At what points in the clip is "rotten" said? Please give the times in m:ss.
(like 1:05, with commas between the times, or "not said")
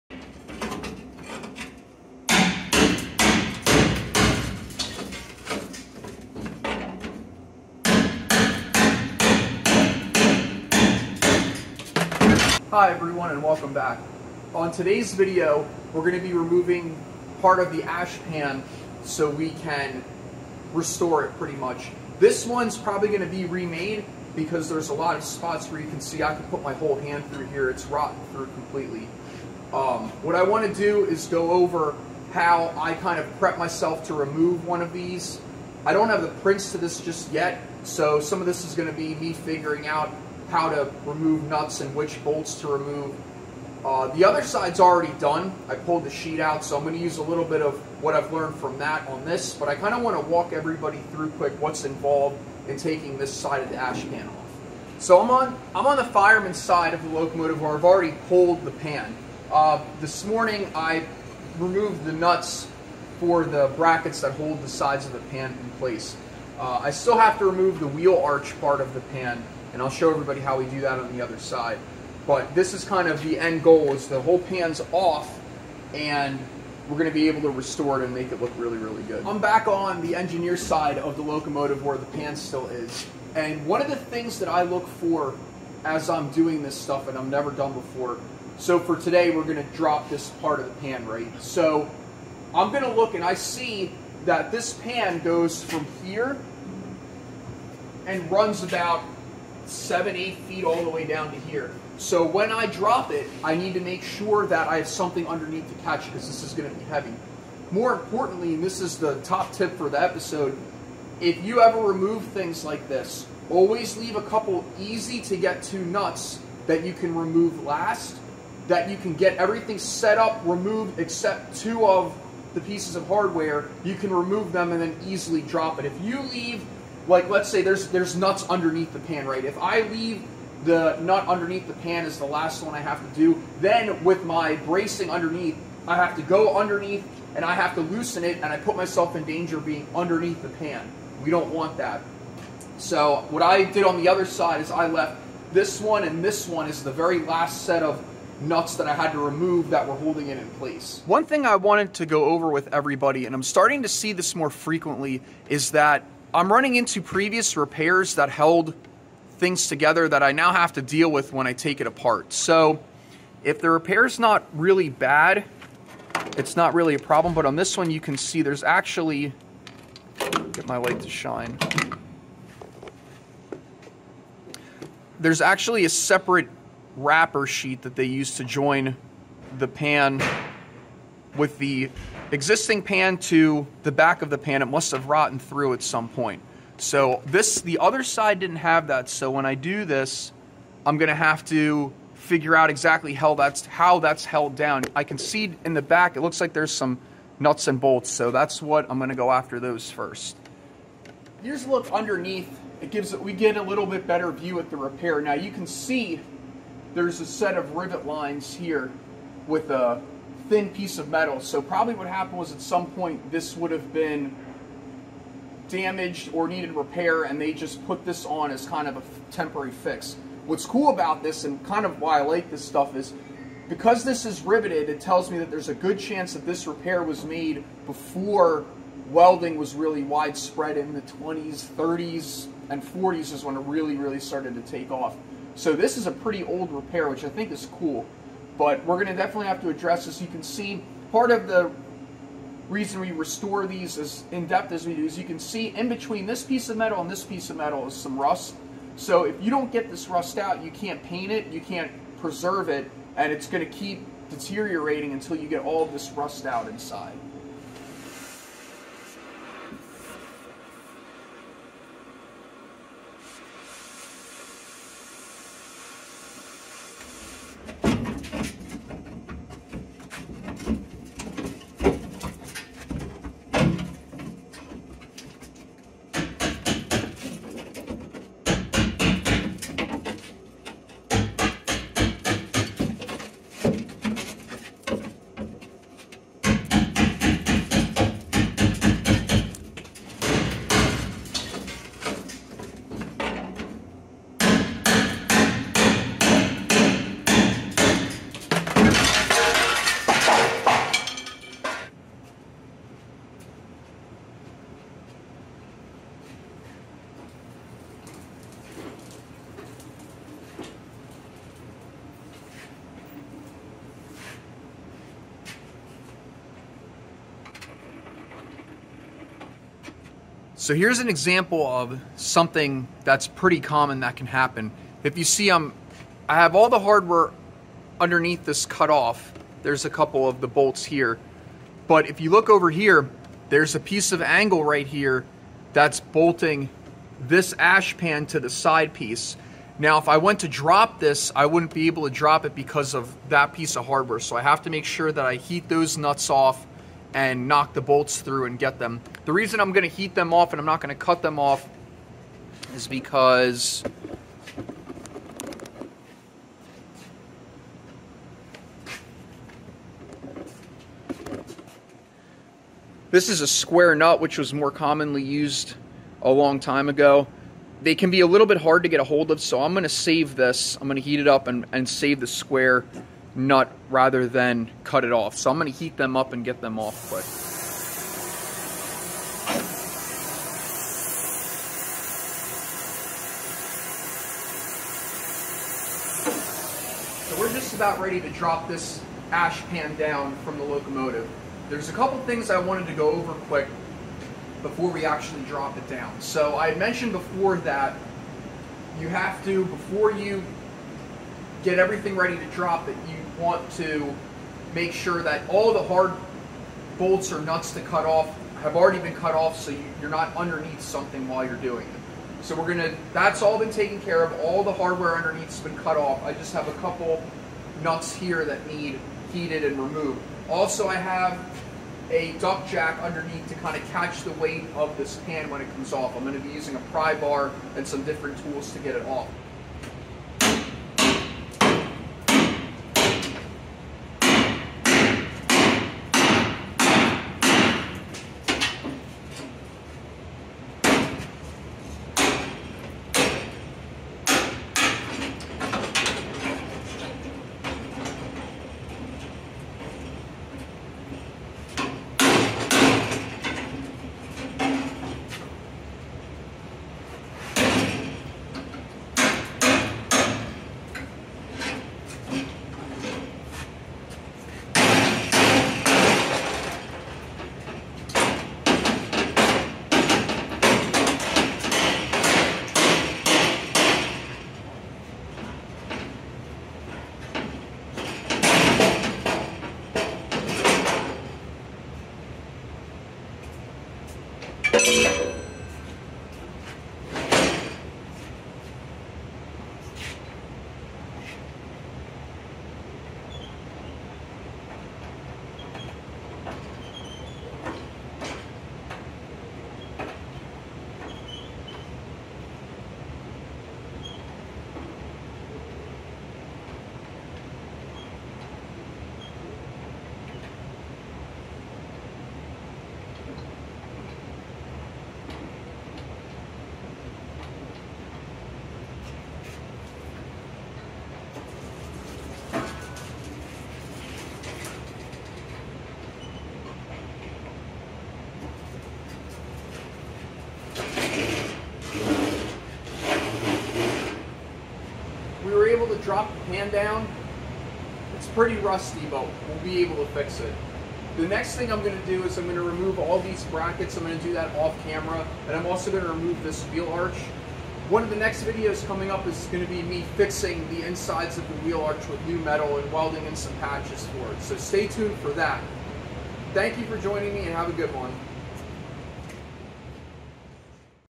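0:27, 3:05.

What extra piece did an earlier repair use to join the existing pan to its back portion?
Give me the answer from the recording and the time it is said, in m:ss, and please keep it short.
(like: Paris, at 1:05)
Wrapper sheet, at 2:56.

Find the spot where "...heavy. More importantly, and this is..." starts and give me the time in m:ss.
1:46.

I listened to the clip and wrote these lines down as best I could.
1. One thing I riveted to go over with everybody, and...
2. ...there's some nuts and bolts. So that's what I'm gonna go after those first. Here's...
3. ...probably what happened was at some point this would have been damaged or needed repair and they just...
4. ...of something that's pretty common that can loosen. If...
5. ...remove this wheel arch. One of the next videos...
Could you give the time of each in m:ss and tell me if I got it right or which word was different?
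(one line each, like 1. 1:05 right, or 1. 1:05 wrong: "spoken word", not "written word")
1. 2:31 wrong: "wanted", not "riveted"
2. 3:16 right
3. 3:31 right
4. 5:21 wrong: "happen", not "loosen"
5. 9:06 right.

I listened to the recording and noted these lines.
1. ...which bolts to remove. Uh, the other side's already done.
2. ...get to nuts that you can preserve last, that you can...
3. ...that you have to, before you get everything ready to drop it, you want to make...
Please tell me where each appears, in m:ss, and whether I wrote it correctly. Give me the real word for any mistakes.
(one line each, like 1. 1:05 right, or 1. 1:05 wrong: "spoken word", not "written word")
1. 0:41 right
2. 1:55 wrong: "remove", not "preserve"
3. 6:37 right.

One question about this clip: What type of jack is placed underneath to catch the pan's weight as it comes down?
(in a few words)
Duck jack.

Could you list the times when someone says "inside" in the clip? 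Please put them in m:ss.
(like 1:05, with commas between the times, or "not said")
4:16, 9:10.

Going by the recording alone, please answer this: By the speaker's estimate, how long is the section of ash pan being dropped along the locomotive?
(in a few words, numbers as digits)
7 or 8 feet.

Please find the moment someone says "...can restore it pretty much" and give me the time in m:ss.
0:19.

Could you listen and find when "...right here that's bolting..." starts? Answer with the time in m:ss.
5:34.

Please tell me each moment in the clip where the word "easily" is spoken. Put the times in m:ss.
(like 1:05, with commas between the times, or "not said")
2:05.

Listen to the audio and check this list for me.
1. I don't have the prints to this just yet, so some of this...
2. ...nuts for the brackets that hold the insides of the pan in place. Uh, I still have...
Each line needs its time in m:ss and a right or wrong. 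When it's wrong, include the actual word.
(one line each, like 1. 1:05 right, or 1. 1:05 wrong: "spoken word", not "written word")
1. 0:35 right
2. 1:02 wrong: "sides", not "insides".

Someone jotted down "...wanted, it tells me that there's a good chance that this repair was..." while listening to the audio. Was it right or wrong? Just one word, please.
wrong.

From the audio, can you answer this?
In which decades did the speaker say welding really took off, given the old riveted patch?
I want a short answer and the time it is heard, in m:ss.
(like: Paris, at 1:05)
20s, 30s, and 40s, at 3:51.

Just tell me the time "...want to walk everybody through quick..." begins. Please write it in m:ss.
0:50.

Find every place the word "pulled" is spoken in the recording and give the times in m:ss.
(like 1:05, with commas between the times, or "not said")
0:45, 0:58.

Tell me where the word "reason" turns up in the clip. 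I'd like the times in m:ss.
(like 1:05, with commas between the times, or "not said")
4:02, 5:49.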